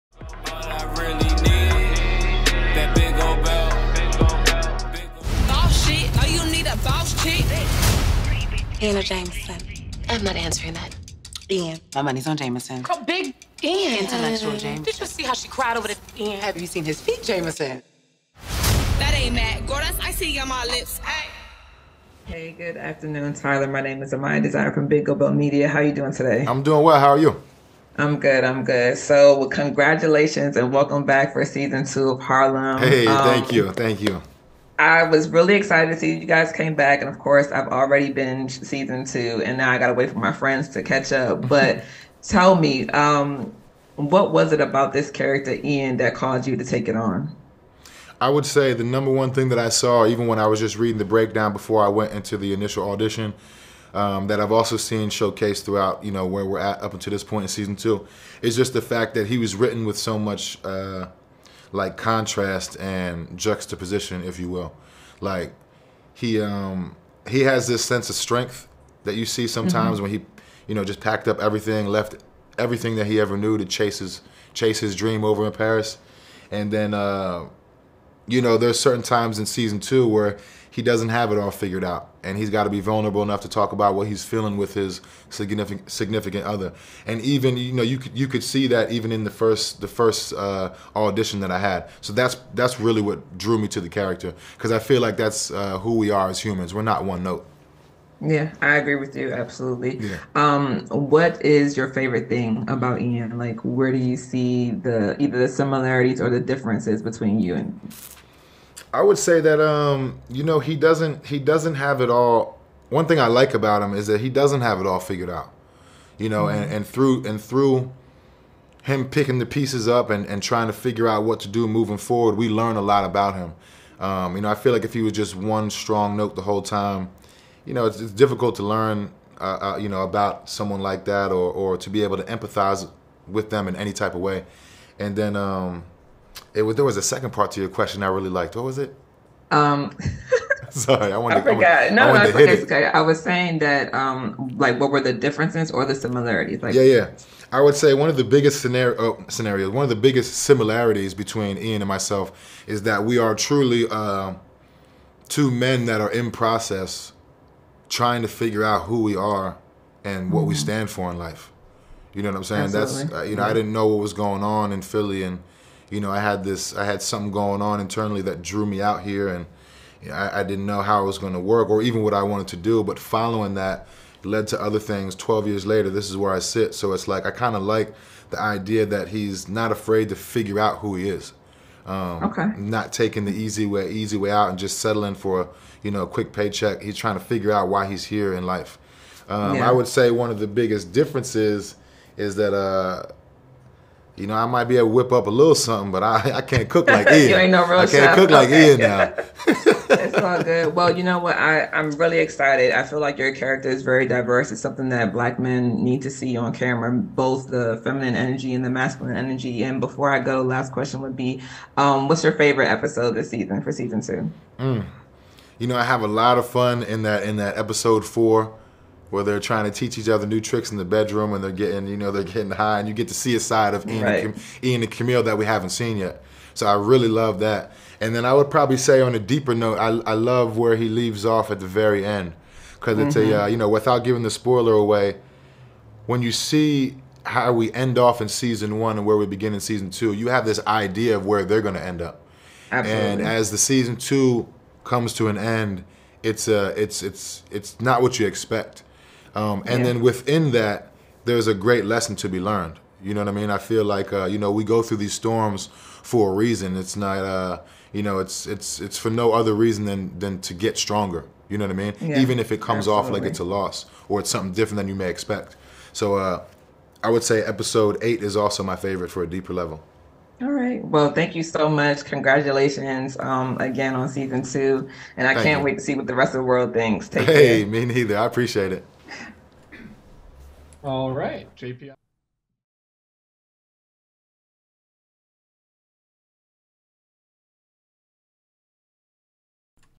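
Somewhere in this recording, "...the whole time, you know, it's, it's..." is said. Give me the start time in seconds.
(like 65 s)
126 s.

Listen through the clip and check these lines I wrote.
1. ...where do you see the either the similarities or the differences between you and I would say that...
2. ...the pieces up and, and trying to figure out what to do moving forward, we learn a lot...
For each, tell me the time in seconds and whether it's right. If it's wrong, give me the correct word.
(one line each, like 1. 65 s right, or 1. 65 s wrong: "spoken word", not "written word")
1. 103 s right
2. 119 s right.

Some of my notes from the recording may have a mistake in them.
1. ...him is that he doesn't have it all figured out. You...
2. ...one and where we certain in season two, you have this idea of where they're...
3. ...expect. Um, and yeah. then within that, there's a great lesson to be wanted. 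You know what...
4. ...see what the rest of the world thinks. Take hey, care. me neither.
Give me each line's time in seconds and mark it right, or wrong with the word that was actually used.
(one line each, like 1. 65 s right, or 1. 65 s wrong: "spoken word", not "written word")
1. 113 s right
2. 238 s wrong: "begin", not "certain"
3. 248 s wrong: "learned", not "wanted"
4. 275 s right.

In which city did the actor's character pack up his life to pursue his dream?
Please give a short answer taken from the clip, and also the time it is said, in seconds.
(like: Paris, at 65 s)
Paris, at 75 s.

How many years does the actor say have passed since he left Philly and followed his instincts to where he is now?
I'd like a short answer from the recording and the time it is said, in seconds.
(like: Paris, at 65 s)
12, at 175 s.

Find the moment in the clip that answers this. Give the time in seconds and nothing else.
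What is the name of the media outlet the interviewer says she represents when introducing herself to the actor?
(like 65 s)
24 s.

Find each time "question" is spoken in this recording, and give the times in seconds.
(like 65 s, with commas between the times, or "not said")
137 s, 210 s.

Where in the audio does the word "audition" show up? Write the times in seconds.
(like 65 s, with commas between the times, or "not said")
52 s, 90 s.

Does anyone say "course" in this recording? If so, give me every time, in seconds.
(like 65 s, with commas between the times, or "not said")
37 s.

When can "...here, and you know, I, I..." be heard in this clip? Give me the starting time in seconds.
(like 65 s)
169 s.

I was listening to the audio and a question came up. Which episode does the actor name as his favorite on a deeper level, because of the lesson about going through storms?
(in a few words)
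Episode 8.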